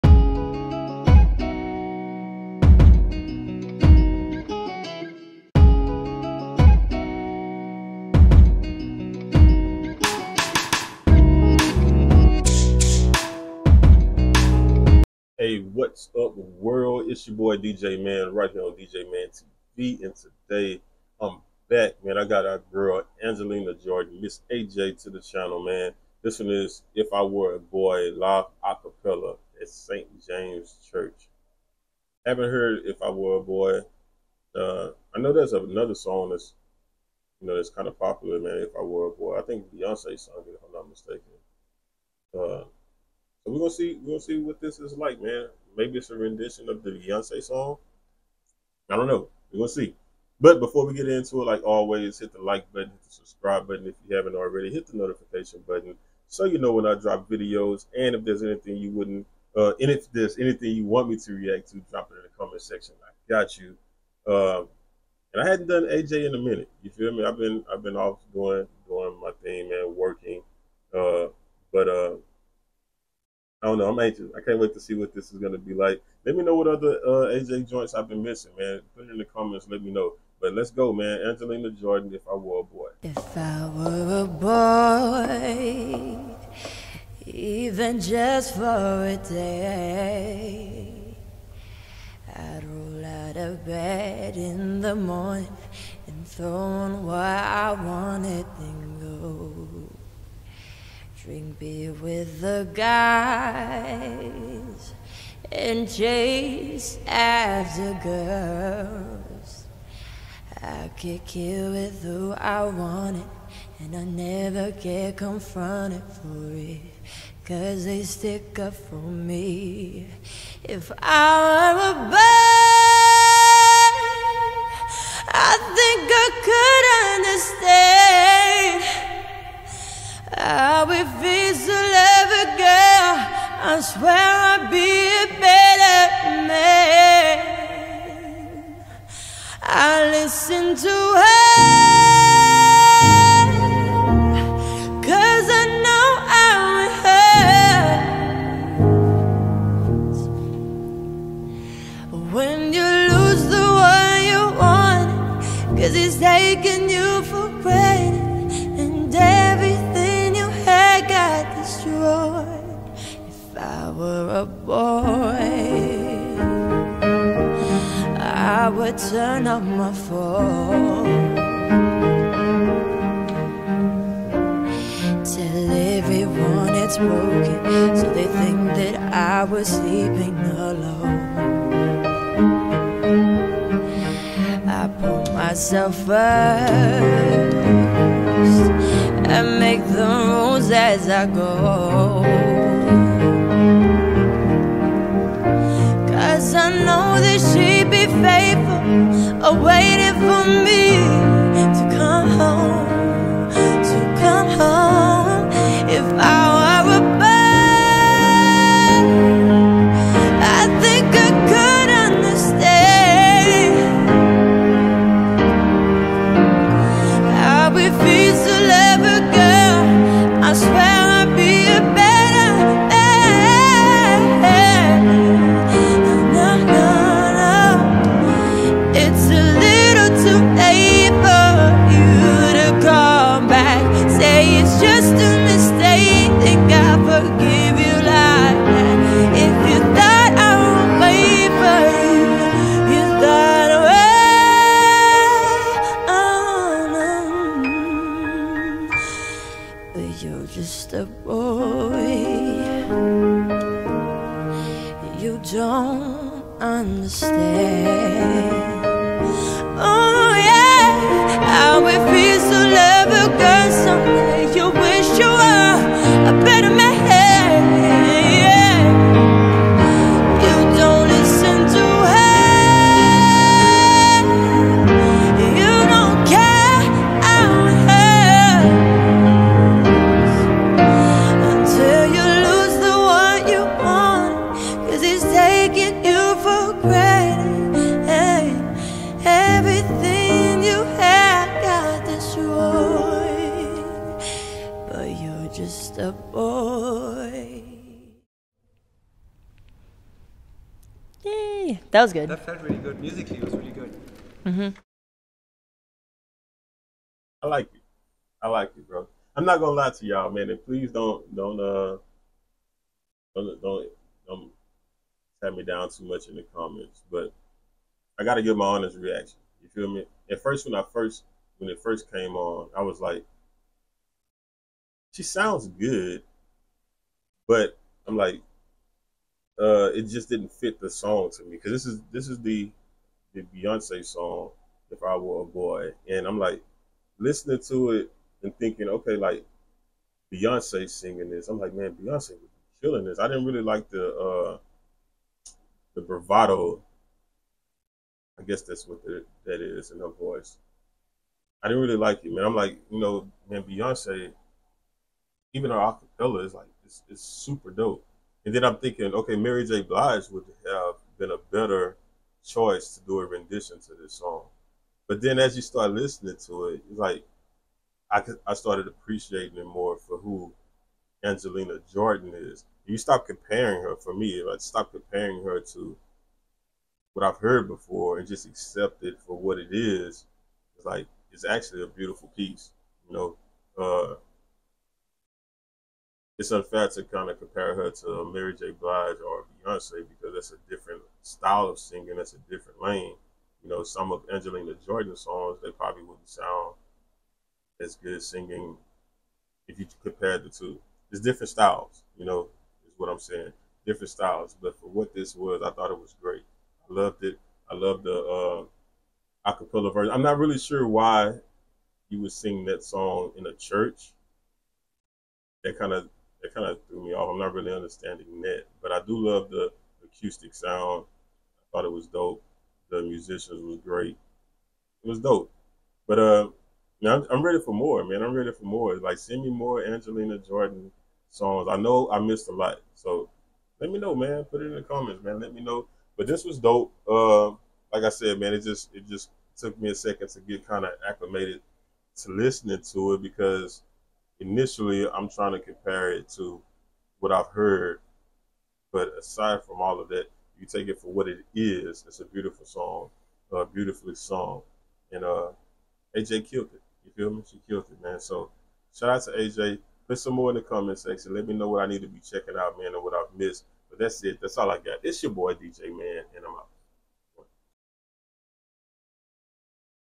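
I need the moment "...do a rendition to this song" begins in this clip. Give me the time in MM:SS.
06:03.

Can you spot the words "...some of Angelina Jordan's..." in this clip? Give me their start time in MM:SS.
06:33.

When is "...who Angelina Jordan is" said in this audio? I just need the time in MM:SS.
06:10.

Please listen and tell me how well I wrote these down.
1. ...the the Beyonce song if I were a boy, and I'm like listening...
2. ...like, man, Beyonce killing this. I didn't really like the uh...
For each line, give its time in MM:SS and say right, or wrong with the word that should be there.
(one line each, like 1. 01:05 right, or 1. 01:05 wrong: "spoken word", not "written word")
1. 05:32 right
2. 05:41 right.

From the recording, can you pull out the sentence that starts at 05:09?
I'm not gonna lie to y'all, man.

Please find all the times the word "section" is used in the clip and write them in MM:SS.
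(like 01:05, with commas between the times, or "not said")
01:02, 07:40.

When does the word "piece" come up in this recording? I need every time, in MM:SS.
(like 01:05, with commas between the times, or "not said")
06:22.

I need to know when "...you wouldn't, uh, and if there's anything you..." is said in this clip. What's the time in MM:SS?
00:58.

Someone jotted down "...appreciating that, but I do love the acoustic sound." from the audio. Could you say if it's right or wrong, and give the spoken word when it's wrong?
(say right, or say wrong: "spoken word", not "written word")
wrong: "understanding", not "appreciating".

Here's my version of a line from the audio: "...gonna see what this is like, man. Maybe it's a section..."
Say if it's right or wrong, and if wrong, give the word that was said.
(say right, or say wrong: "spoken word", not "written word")
wrong: "rendition", not "section".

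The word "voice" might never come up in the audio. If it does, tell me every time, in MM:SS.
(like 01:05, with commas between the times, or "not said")
05:50.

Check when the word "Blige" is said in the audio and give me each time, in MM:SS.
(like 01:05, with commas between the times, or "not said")
05:59, 06:28.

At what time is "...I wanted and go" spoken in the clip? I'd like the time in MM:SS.
01:37.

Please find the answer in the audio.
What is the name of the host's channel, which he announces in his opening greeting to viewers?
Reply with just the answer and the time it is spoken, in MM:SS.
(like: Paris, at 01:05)
DJ Mann TV, at 00:18.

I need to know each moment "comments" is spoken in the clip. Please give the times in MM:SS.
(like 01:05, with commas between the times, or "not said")
01:02, 01:19, 05:16, 07:14, 07:40.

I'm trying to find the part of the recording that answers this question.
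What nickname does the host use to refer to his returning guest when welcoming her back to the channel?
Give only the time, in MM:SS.
00:24.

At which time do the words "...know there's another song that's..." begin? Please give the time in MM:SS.
00:35.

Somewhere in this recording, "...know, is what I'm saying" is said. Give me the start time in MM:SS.
06:42.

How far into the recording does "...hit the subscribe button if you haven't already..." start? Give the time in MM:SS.
00:52.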